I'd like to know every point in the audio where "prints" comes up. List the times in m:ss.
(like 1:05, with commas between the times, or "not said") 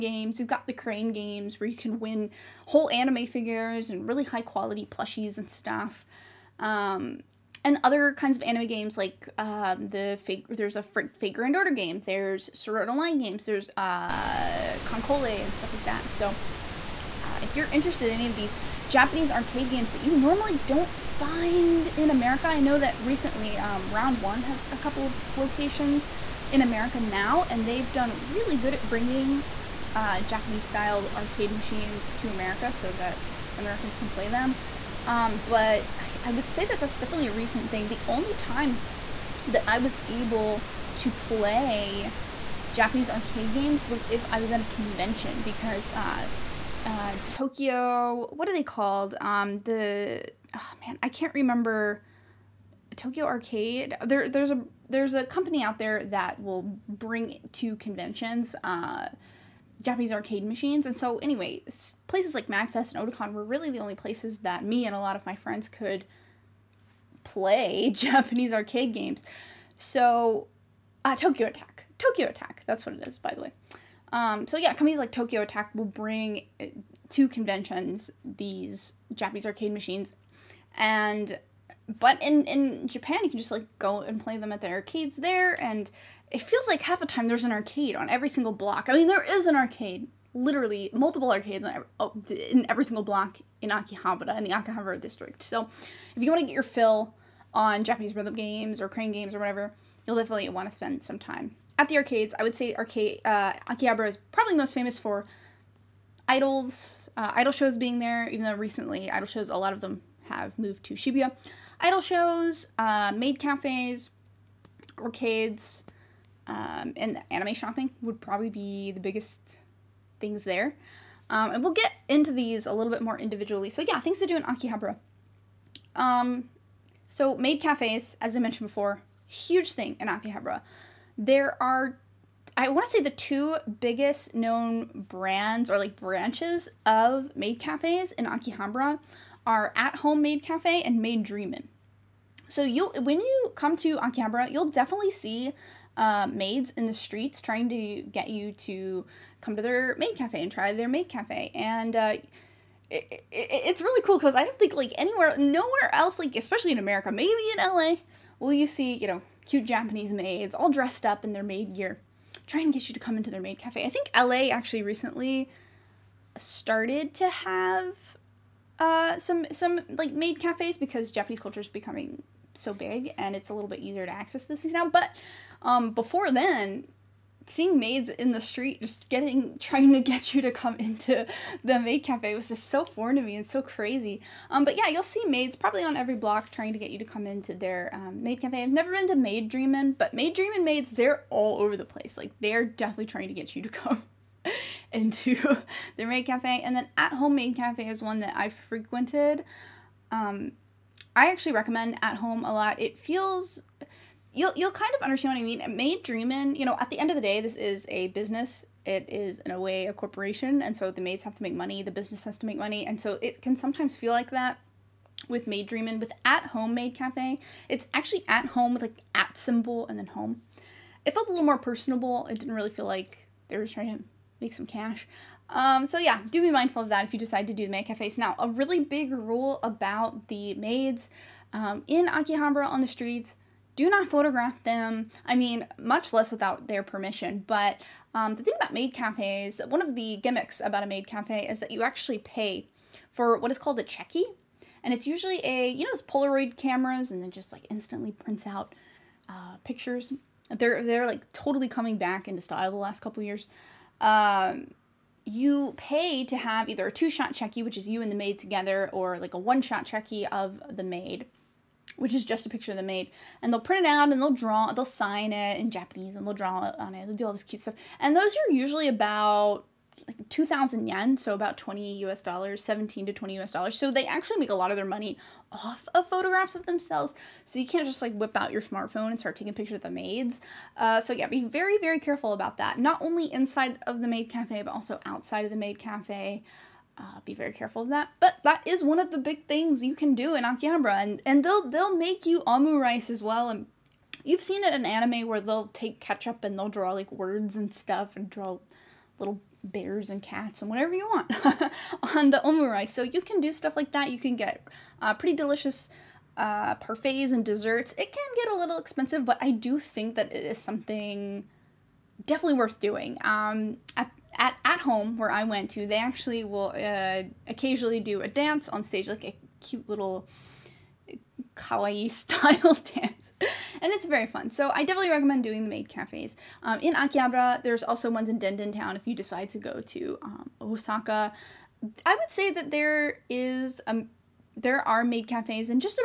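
4:08, 4:23.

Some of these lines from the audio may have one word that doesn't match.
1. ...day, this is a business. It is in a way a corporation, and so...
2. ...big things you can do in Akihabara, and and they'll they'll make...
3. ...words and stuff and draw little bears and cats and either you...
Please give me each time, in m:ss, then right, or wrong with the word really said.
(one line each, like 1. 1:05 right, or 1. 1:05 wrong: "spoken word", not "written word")
1. 3:27 right
2. 4:49 right
3. 4:57 wrong: "whatever", not "either".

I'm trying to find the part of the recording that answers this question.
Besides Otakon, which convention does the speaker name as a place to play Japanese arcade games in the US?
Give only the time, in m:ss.
1:02.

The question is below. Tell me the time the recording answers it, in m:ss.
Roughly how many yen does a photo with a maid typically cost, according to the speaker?
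4:30.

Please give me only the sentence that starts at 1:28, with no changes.
I mean, there is an arcade, literally multiple arcades on every, oh, in every single block in Akihabara in the Akihabara district.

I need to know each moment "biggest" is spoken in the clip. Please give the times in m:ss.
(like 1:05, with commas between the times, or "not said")
1:59, 2:13.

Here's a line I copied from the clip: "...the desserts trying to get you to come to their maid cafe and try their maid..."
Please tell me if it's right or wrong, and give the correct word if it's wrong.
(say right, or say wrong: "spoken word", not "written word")
wrong: "streets", not "desserts".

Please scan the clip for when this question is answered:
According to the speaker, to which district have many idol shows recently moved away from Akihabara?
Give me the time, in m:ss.
1:50.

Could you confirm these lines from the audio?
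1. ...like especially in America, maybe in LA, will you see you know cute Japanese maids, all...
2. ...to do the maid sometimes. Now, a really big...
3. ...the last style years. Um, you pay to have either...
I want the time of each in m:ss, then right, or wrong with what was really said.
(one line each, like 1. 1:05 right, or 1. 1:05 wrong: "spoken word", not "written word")
1. 2:36 right
2. 3:47 wrong: "cafes", not "sometimes"
3. 4:12 wrong: "couple", not "style".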